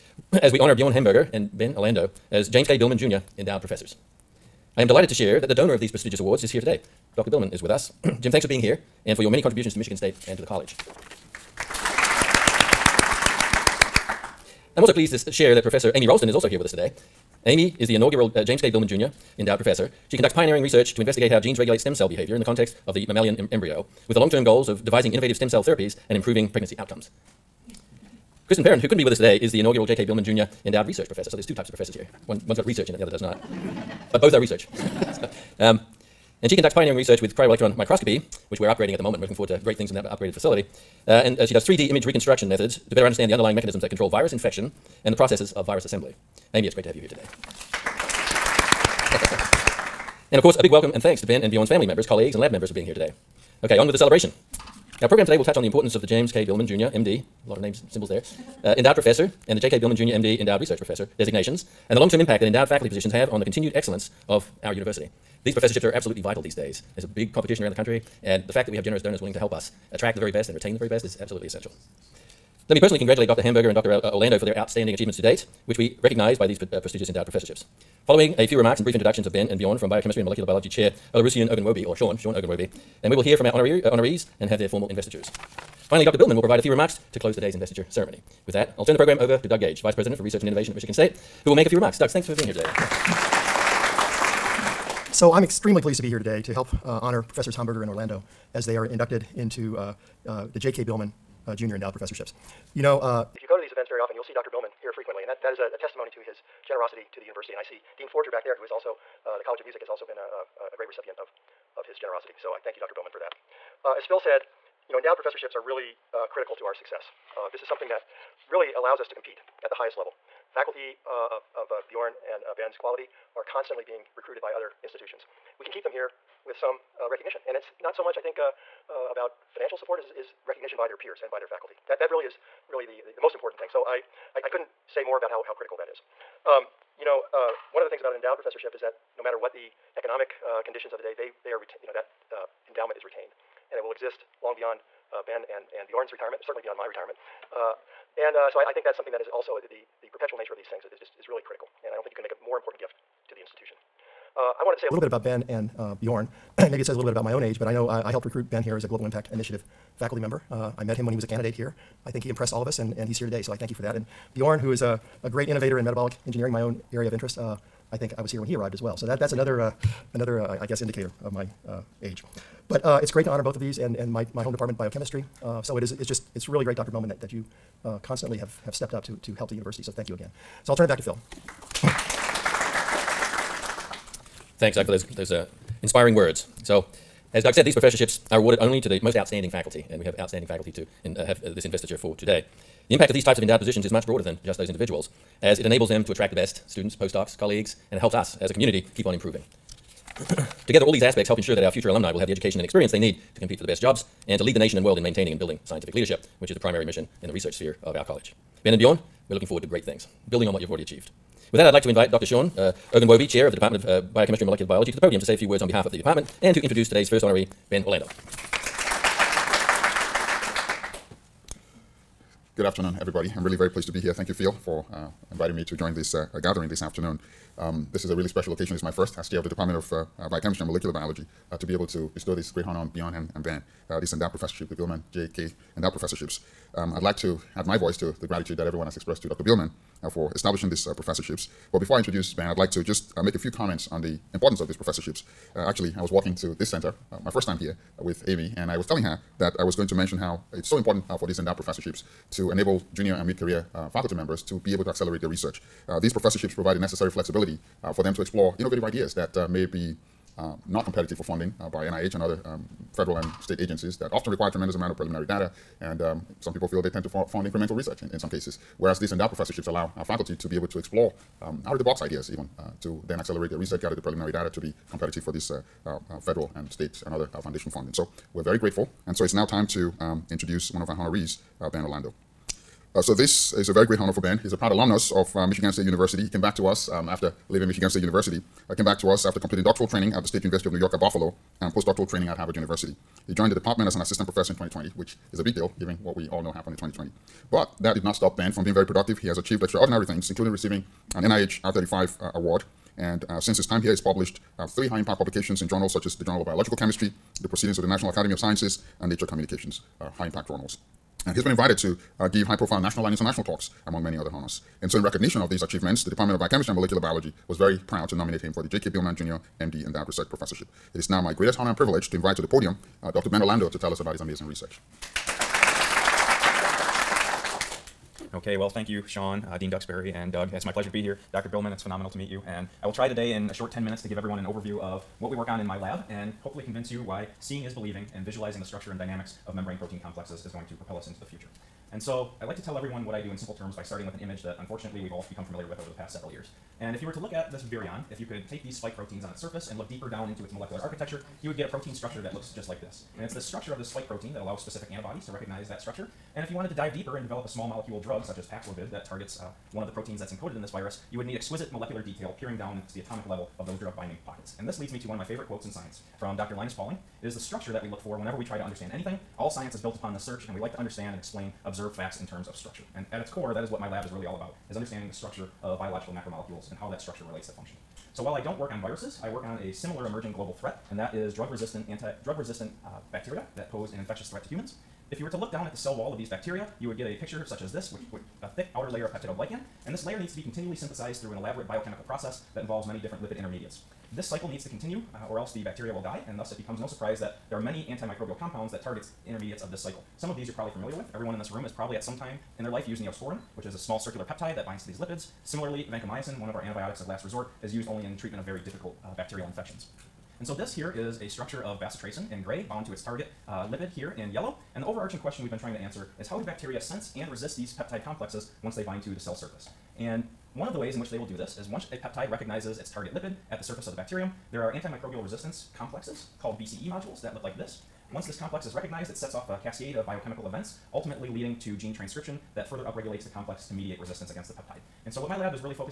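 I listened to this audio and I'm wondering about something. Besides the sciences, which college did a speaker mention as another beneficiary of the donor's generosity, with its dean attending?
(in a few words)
College of Music.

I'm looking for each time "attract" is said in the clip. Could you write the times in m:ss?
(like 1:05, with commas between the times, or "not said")
1:09, 3:16.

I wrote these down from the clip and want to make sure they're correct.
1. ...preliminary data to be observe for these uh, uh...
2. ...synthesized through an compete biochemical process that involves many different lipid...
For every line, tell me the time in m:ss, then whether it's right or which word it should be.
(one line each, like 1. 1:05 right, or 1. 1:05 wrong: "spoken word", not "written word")
1. 4:34 wrong: "competitive", not "observe"
2. 6:30 wrong: "elaborate", not "compete".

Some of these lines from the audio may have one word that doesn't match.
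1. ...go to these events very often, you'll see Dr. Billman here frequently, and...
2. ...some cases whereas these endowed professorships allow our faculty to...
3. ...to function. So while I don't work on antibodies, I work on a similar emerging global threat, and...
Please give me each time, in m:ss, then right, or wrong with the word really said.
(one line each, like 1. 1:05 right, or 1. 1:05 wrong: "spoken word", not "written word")
1. 1:43 right
2. 4:28 right
3. 6:17 wrong: "viruses", not "antibodies".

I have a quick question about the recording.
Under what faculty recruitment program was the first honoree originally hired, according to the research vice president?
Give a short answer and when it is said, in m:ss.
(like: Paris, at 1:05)
Global Impact Initiative, at 2:38.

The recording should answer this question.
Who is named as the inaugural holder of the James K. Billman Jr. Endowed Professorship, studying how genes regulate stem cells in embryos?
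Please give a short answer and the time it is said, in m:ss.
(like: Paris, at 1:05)
Amy Ralston, at 0:15.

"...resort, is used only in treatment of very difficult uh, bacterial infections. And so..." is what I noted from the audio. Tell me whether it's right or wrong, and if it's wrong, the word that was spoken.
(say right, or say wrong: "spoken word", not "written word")
right.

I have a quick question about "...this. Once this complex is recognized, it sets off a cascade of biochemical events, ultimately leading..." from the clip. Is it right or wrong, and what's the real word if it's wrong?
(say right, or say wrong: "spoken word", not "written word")
right.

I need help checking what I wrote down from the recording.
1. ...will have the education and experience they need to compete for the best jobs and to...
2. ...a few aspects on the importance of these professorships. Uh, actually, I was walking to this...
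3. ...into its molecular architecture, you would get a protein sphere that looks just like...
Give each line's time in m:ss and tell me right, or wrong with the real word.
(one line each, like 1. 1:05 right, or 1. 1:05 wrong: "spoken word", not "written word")
1. 3:22 right
2. 4:03 wrong: "comments", not "aspects"
3. 5:50 wrong: "structure", not "sphere".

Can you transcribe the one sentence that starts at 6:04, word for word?
And this leads me to one of my favorite quotes in science from Dr.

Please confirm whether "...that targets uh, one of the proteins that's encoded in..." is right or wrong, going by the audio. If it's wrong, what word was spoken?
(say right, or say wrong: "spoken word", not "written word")
right.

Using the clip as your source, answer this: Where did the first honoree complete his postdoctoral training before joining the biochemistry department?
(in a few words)
Harvard University.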